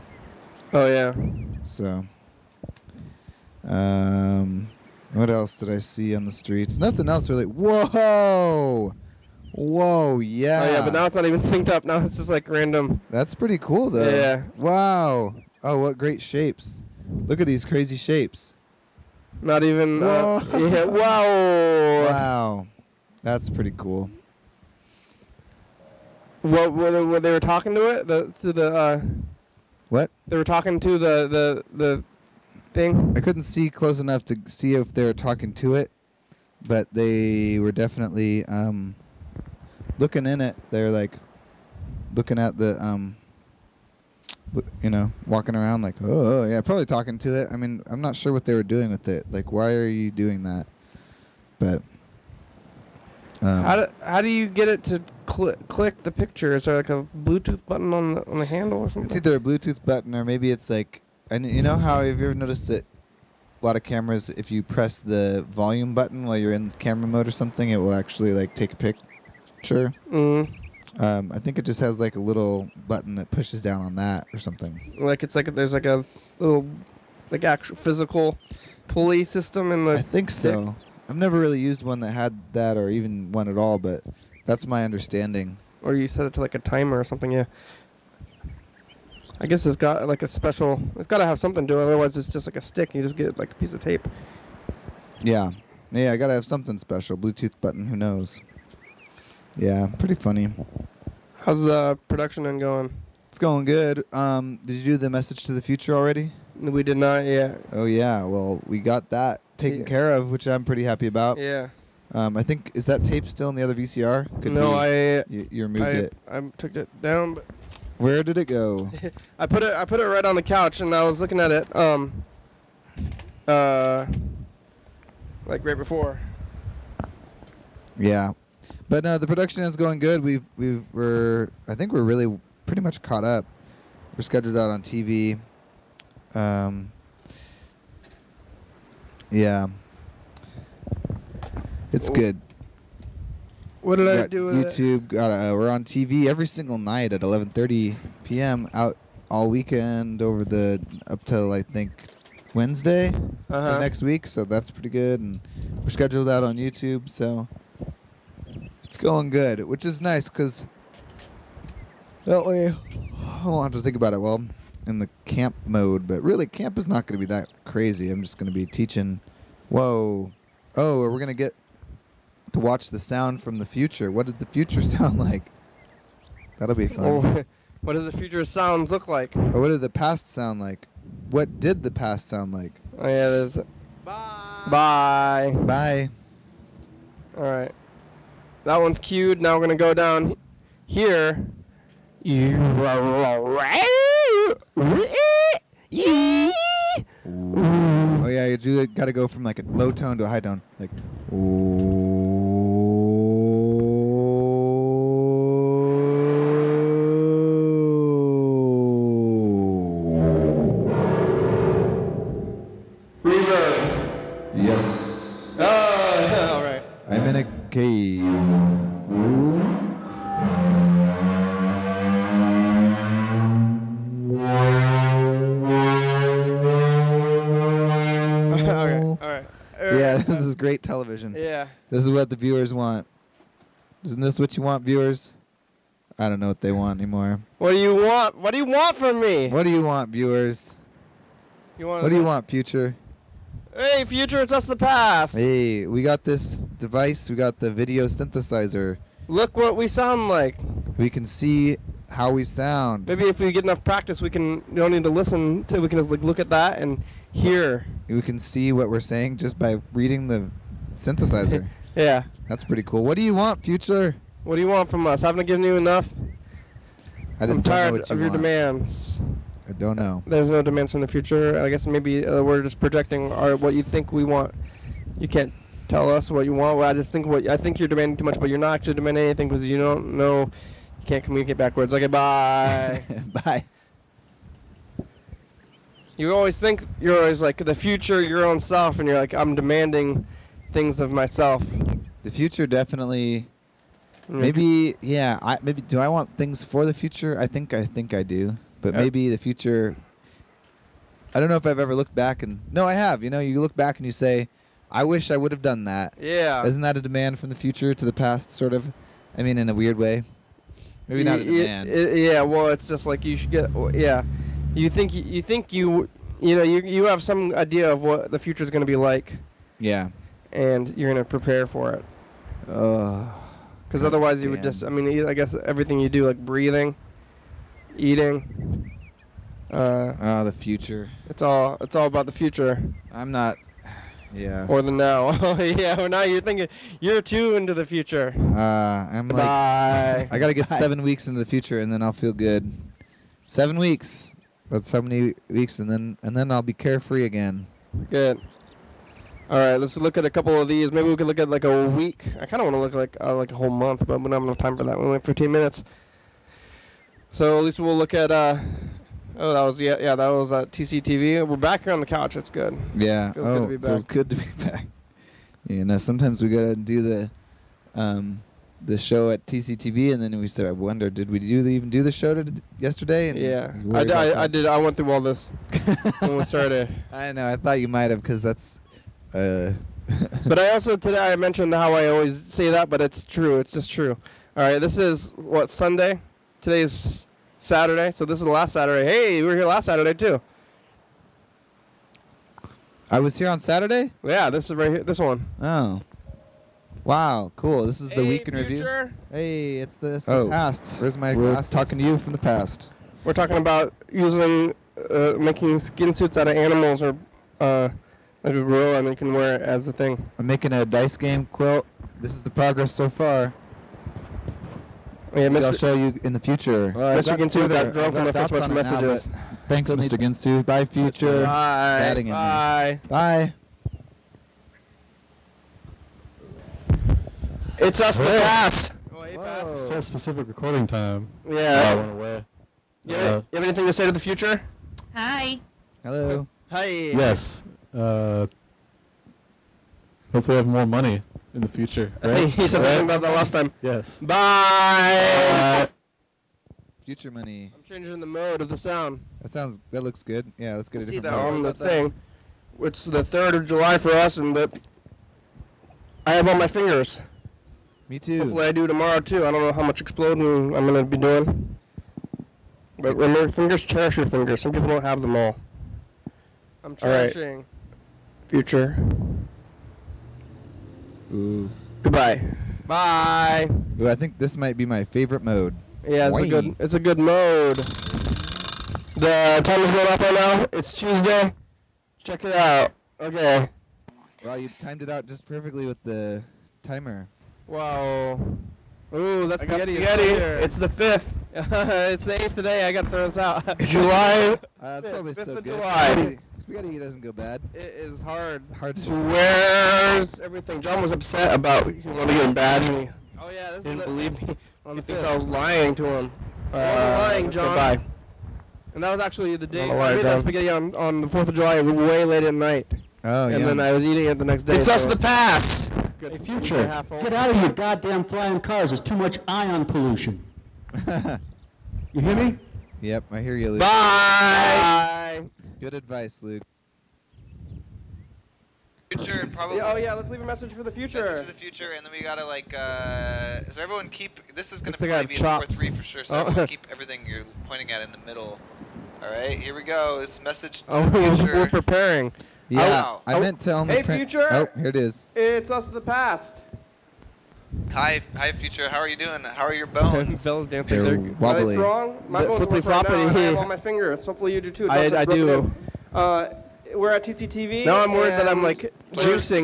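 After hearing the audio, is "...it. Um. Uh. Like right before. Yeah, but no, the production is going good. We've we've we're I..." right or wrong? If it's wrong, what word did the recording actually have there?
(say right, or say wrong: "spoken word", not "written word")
right.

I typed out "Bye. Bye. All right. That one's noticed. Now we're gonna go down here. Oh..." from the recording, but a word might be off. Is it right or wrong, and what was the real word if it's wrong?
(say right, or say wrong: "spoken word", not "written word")
wrong: "queued", not "noticed".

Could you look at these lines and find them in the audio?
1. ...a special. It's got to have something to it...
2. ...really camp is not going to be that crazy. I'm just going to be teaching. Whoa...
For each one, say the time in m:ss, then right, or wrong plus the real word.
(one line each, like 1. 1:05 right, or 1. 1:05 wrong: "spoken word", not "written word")
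1. 1:30 right
2. 2:46 right.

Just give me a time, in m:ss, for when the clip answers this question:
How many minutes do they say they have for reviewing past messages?
5:55.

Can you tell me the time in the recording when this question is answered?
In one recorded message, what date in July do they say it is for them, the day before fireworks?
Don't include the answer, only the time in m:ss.
7:33.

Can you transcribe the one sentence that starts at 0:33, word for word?
I couldn't see close enough to see if they were talking to it, but they were definitely um, looking in it.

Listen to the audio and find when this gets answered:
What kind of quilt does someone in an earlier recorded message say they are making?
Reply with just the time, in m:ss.
6:50.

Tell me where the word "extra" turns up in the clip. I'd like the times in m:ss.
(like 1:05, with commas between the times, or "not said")
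not said.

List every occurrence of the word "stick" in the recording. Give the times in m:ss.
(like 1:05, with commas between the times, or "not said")
1:20, 1:32.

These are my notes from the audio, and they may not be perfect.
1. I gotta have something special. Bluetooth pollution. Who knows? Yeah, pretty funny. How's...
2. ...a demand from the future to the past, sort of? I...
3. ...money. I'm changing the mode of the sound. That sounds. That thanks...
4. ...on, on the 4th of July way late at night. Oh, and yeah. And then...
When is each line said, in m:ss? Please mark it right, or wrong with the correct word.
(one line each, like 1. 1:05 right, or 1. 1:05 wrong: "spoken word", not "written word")
1. 1:36 wrong: "button", not "pollution"
2. 5:06 right
3. 7:27 wrong: "looks", not "thanks"
4. 8:30 right.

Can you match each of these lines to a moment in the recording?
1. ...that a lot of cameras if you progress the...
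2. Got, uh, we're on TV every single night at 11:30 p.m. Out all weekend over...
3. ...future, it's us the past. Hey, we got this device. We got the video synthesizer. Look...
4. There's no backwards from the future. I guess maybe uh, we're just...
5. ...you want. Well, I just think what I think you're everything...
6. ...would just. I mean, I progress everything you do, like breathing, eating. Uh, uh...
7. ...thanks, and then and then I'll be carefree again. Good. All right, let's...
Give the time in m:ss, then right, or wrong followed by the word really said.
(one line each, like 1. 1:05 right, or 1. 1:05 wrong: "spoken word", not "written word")
1. 1:02 wrong: "press", not "progress"
2. 2:25 right
3. 4:04 right
4. 4:30 wrong: "demands", not "backwards"
5. 4:36 wrong: "demanding", not "everything"
6. 5:24 wrong: "guess", not "progress"
7. 5:45 wrong: "weeks", not "thanks".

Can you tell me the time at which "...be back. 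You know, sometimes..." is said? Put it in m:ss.
6:04.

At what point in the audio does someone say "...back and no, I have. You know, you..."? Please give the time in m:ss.
5:02.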